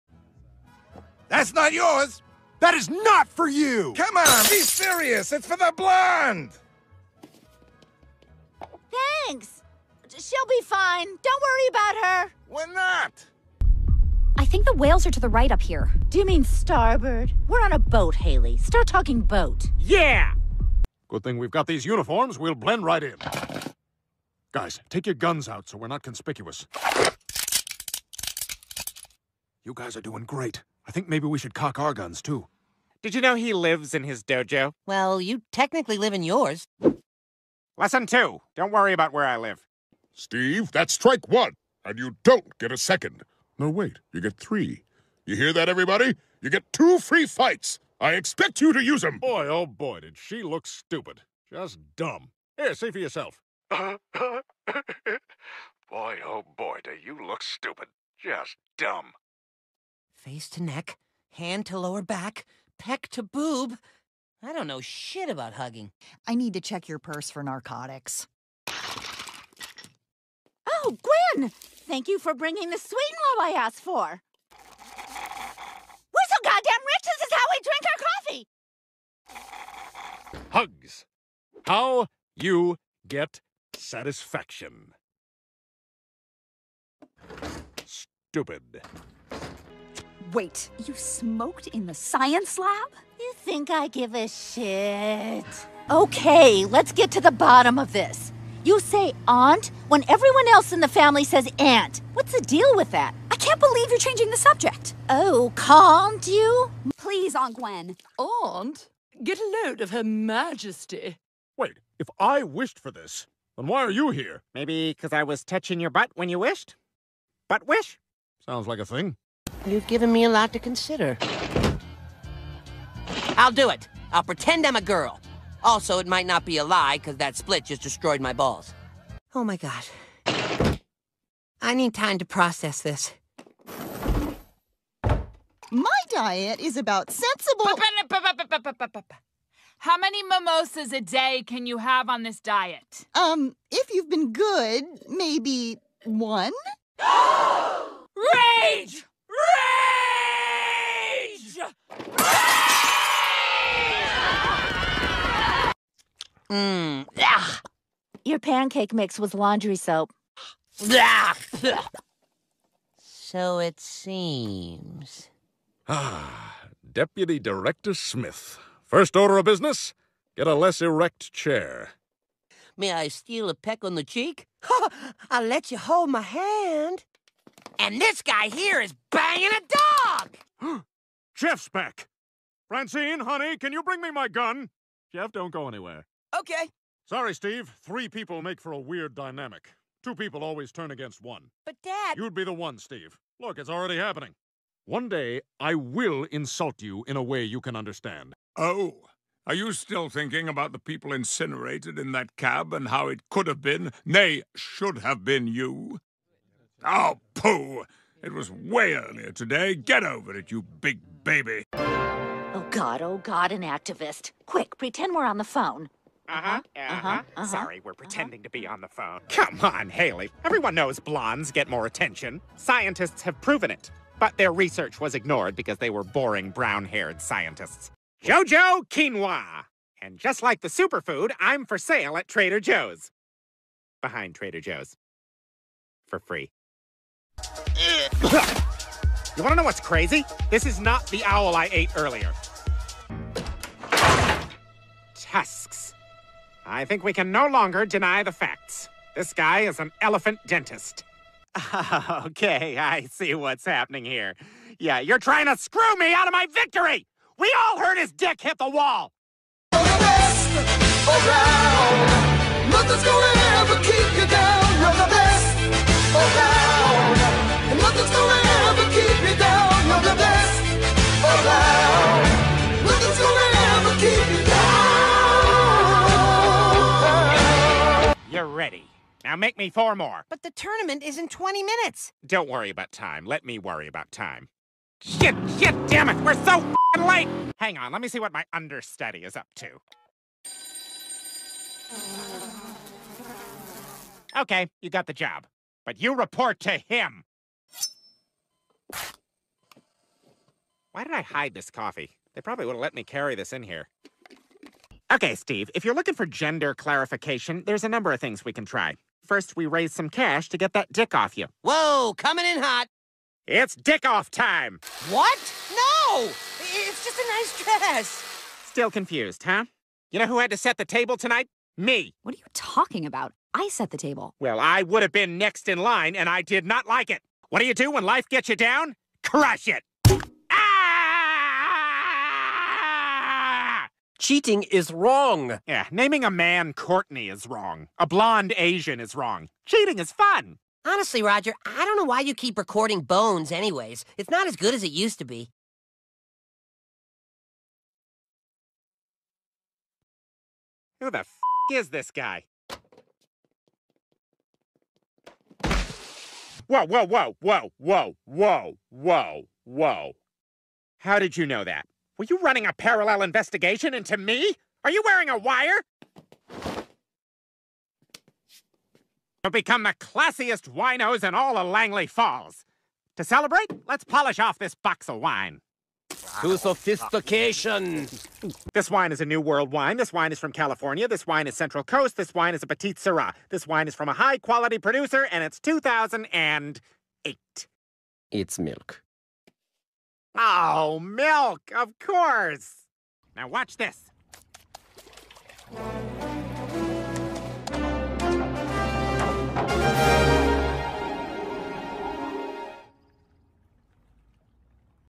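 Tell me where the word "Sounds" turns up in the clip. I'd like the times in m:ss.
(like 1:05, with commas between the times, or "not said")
1:58.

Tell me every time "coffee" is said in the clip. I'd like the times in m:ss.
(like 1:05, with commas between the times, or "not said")
1:20, 5:01.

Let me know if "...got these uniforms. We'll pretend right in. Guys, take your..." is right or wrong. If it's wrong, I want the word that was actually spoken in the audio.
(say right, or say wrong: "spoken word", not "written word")
wrong: "blend", not "pretend".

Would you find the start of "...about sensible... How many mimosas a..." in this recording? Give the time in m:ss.
2:16.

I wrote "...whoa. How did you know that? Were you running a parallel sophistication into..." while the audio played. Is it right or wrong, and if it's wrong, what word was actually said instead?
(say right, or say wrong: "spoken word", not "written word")
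wrong: "investigation", not "sophistication".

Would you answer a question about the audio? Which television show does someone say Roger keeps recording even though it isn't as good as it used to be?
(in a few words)
Bones.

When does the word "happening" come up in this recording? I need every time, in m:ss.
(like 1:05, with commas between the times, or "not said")
3:13, 4:13.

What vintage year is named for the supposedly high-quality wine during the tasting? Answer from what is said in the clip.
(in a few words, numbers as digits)
2008.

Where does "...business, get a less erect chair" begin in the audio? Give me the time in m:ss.
2:49.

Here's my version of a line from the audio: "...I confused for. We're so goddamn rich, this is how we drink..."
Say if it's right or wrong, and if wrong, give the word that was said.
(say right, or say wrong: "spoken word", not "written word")
wrong: "asked", not "confused".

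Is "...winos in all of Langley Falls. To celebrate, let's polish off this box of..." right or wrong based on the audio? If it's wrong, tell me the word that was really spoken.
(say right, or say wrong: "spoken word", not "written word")
right.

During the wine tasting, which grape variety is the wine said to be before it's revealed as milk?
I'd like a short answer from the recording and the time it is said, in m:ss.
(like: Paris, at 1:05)
Petite Sirah, at 6:22.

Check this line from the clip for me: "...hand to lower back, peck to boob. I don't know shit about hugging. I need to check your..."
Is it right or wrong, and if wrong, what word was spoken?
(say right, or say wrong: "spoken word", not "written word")
right.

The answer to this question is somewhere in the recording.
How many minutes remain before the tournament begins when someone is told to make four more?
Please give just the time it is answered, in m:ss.
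4:41.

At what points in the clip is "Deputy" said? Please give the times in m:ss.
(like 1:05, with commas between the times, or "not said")
2:46.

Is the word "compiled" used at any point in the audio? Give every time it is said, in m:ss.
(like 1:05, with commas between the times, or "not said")
not said.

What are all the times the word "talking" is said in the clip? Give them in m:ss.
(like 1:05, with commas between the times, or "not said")
0:18, 5:22.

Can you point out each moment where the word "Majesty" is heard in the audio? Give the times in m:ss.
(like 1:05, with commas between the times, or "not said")
1:50.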